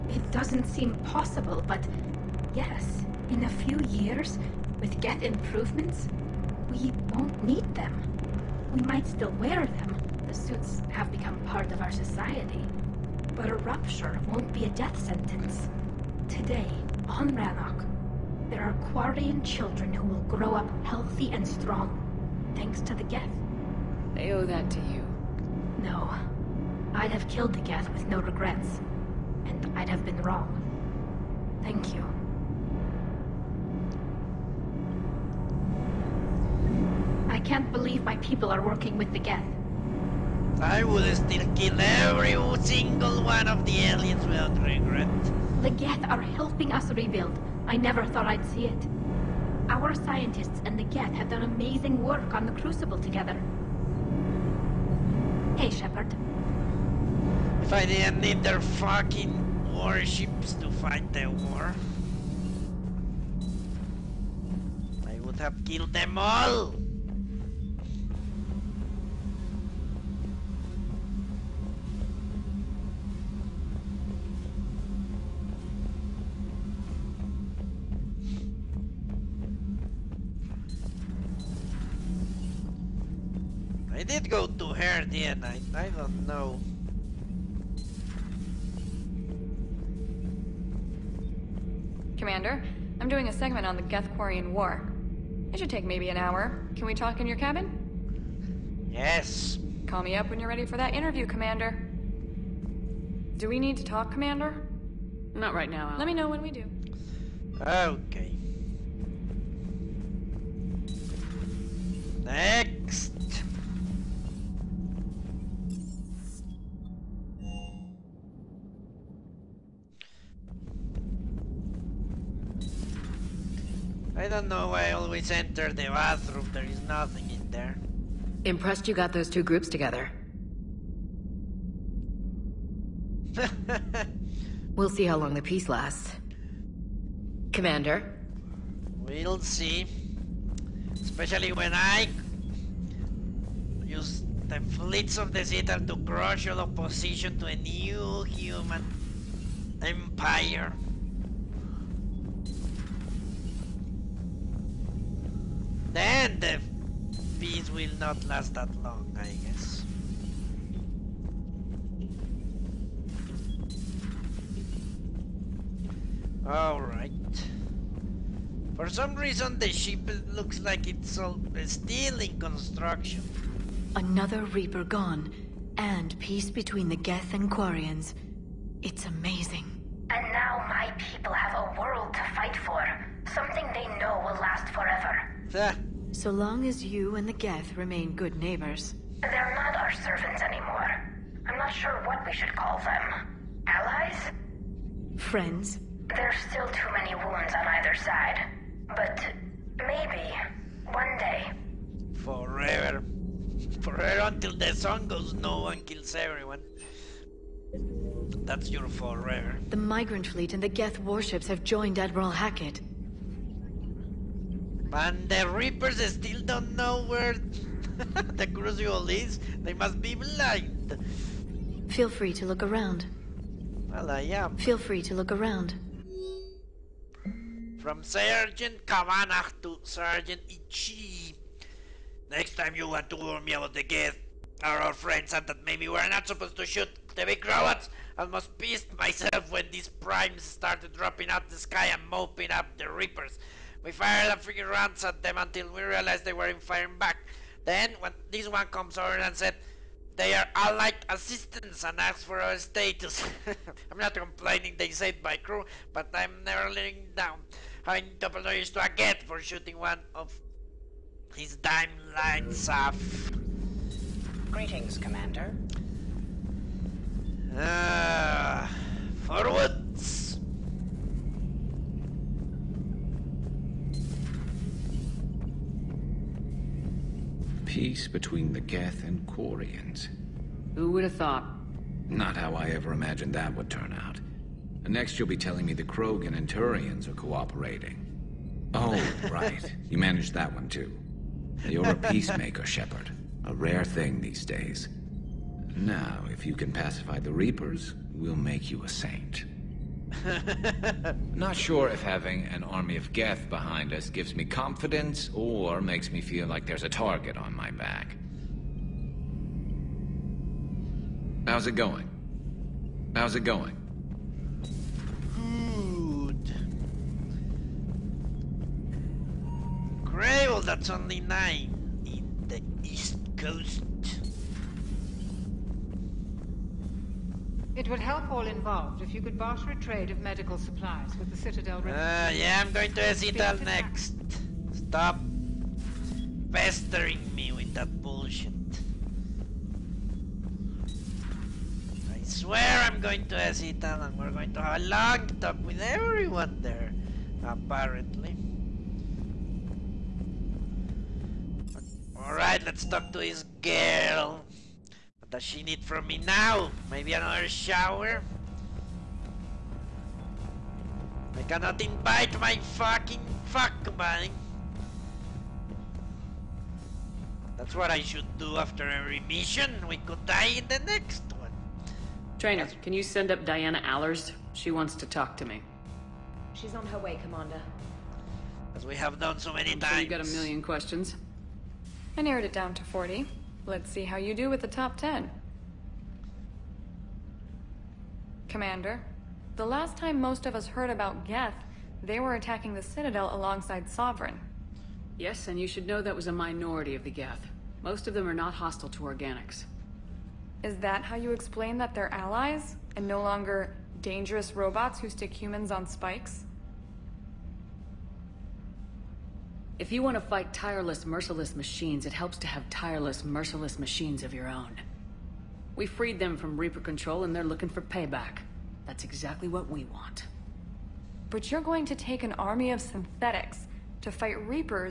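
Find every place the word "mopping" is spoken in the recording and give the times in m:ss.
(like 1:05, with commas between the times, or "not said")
4:02.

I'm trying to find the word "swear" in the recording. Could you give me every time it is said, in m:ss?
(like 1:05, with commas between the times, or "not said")
5:42.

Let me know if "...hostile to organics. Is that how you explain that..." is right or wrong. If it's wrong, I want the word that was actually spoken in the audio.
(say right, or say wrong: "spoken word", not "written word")
right.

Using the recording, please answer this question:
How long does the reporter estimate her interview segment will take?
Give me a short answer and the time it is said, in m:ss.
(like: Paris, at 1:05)
An hour, at 1:36.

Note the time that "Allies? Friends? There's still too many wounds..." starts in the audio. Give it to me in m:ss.
3:13.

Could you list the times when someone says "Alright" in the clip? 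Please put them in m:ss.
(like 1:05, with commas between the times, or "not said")
2:46, 5:52.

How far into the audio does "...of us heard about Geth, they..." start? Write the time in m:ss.
6:30.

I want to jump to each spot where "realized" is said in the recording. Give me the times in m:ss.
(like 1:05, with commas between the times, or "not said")
4:05.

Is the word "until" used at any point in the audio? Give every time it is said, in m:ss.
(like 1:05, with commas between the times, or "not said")
3:24, 4:05.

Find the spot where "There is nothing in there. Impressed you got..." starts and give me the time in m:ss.
2:06.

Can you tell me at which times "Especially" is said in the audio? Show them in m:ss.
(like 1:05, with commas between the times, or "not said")
2:20.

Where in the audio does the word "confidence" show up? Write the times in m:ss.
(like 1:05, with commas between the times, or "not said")
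5:04.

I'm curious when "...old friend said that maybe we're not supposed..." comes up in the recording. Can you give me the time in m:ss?
3:54.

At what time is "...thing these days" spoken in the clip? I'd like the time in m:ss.
4:53.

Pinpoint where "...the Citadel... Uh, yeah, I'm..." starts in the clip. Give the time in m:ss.
5:31.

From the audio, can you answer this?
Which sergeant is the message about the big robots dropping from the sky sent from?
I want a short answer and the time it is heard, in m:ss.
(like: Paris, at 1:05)
Sergeant Kavanagh, at 3:48.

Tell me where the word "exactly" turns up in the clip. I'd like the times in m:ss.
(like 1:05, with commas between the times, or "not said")
6:59.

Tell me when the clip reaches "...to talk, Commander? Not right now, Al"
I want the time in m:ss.
1:43.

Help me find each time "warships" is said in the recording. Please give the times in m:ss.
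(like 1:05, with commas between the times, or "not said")
0:59, 3:30.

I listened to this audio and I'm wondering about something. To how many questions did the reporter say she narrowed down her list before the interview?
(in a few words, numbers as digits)
40.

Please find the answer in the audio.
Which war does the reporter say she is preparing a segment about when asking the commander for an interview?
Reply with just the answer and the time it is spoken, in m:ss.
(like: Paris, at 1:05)
Gethkorian War, at 1:33.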